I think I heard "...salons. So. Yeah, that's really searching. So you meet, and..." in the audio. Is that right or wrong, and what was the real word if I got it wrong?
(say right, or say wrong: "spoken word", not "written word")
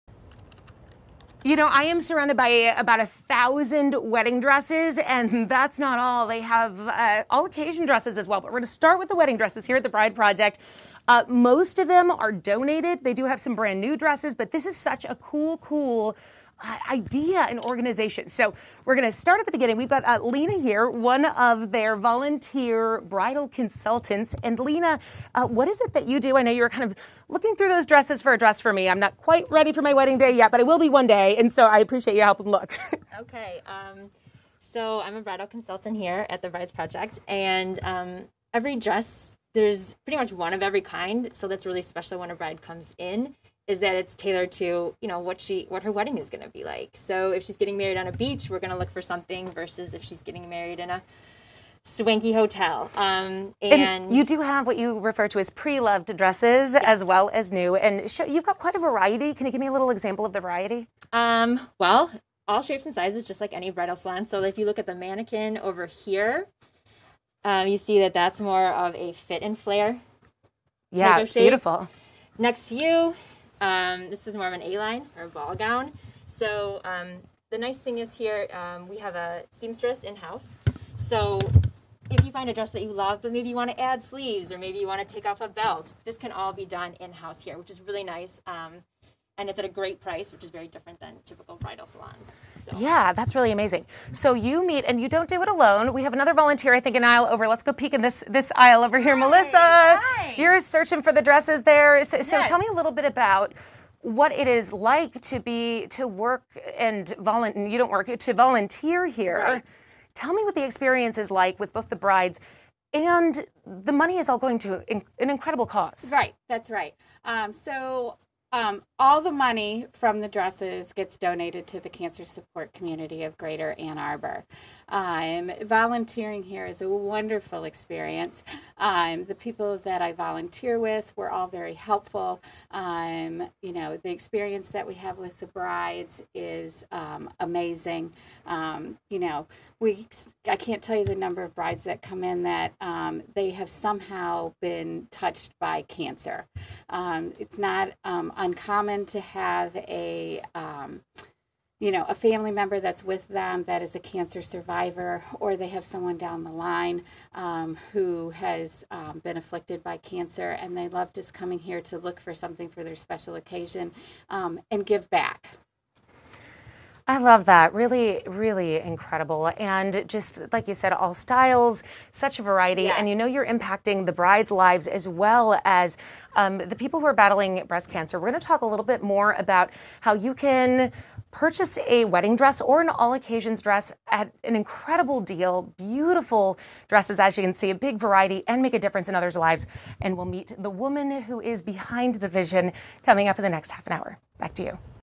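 wrong: "amazing", not "searching".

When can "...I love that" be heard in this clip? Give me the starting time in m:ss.
2:47.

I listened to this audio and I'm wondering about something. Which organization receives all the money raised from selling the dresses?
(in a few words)
Cancer Support Community of Greater Ann Arbor.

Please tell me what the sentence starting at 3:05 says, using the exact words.
Beautiful dresses, as you can see, a big variety and make a difference in others' lives.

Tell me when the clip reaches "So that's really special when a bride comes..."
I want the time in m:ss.
0:41.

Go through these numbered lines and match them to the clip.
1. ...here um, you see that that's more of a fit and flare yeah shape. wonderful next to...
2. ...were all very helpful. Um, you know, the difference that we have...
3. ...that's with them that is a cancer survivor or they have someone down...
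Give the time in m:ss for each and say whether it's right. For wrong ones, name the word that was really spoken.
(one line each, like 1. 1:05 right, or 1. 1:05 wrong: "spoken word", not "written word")
1. 1:05 wrong: "beautiful", not "wonderful"
2. 2:11 wrong: "experience", not "difference"
3. 2:32 right.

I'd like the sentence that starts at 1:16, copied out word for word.
So um, the nice thing is here, um, we have a seamstress in-house.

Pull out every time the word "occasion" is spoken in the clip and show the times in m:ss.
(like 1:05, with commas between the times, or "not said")
0:07, 2:43, 3:03.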